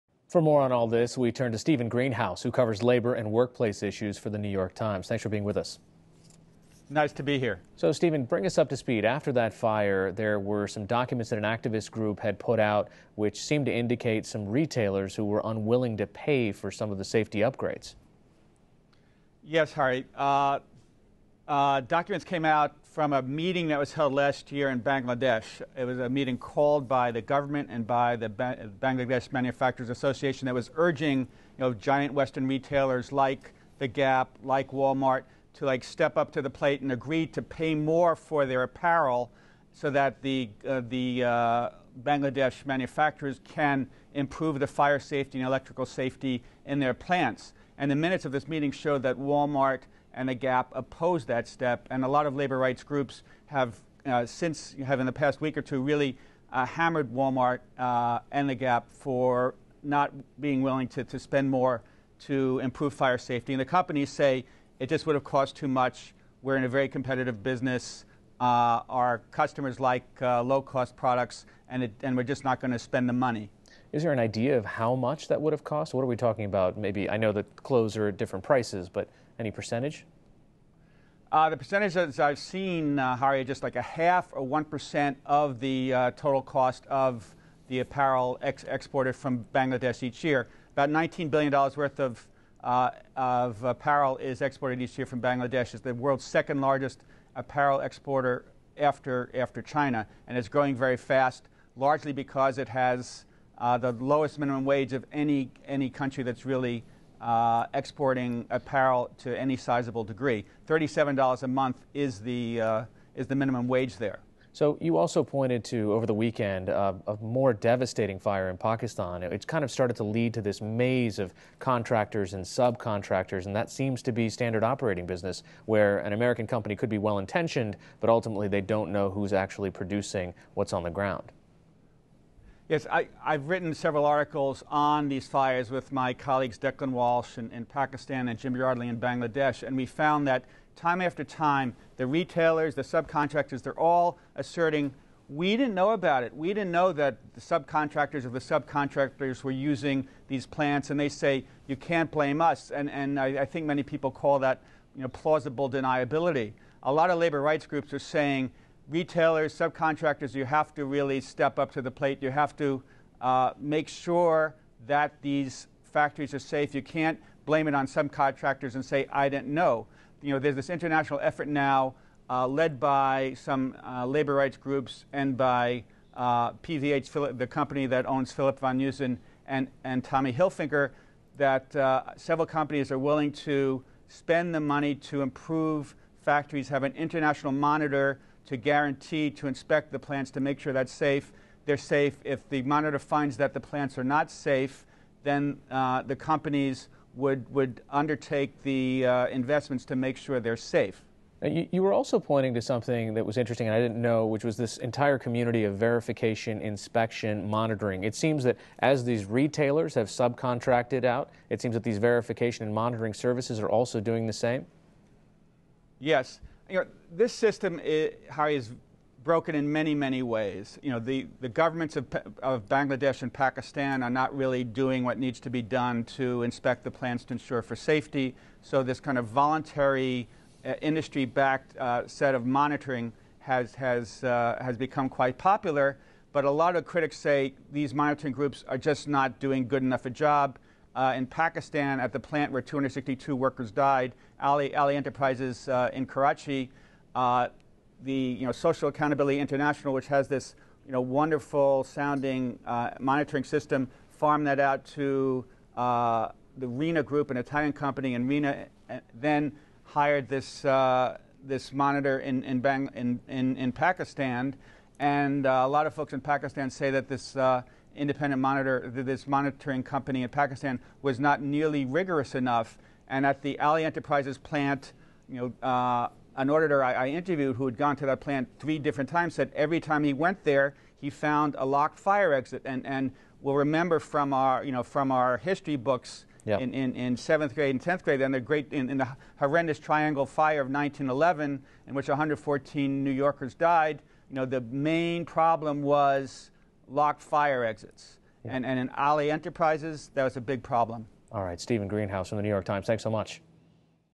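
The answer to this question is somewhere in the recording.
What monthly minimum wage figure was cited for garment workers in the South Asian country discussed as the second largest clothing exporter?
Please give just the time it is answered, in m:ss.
1:50.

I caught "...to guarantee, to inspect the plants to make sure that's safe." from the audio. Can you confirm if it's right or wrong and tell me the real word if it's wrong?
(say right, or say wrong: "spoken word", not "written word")
right.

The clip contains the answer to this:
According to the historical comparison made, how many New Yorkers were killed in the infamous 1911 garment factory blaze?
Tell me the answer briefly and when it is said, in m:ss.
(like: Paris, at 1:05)
114, at 4:52.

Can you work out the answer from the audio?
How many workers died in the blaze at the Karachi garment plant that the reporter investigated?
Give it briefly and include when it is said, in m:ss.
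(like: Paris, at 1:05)
262, at 4:02.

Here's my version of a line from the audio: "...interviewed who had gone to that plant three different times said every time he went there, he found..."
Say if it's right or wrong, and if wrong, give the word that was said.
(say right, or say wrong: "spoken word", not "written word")
right.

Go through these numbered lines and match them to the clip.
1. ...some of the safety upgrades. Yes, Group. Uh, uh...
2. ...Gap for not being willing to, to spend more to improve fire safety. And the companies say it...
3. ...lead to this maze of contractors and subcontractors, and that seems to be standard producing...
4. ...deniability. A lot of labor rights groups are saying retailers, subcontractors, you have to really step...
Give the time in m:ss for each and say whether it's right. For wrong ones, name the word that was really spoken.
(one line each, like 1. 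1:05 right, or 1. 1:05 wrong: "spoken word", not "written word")
1. 0:16 wrong: "Hari", not "Group"
2. 0:58 right
3. 2:00 wrong: "operating", not "producing"
4. 2:35 right.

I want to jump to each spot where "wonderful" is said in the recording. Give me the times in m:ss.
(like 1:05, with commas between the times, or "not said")
4:11.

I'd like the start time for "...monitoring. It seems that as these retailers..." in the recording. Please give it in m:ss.
3:27.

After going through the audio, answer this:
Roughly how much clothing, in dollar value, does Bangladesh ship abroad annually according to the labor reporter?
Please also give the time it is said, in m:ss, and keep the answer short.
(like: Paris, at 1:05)
$19 billion, at 1:30.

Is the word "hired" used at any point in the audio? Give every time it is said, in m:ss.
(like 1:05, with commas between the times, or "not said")
4:19.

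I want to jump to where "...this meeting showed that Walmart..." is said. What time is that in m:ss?
0:48.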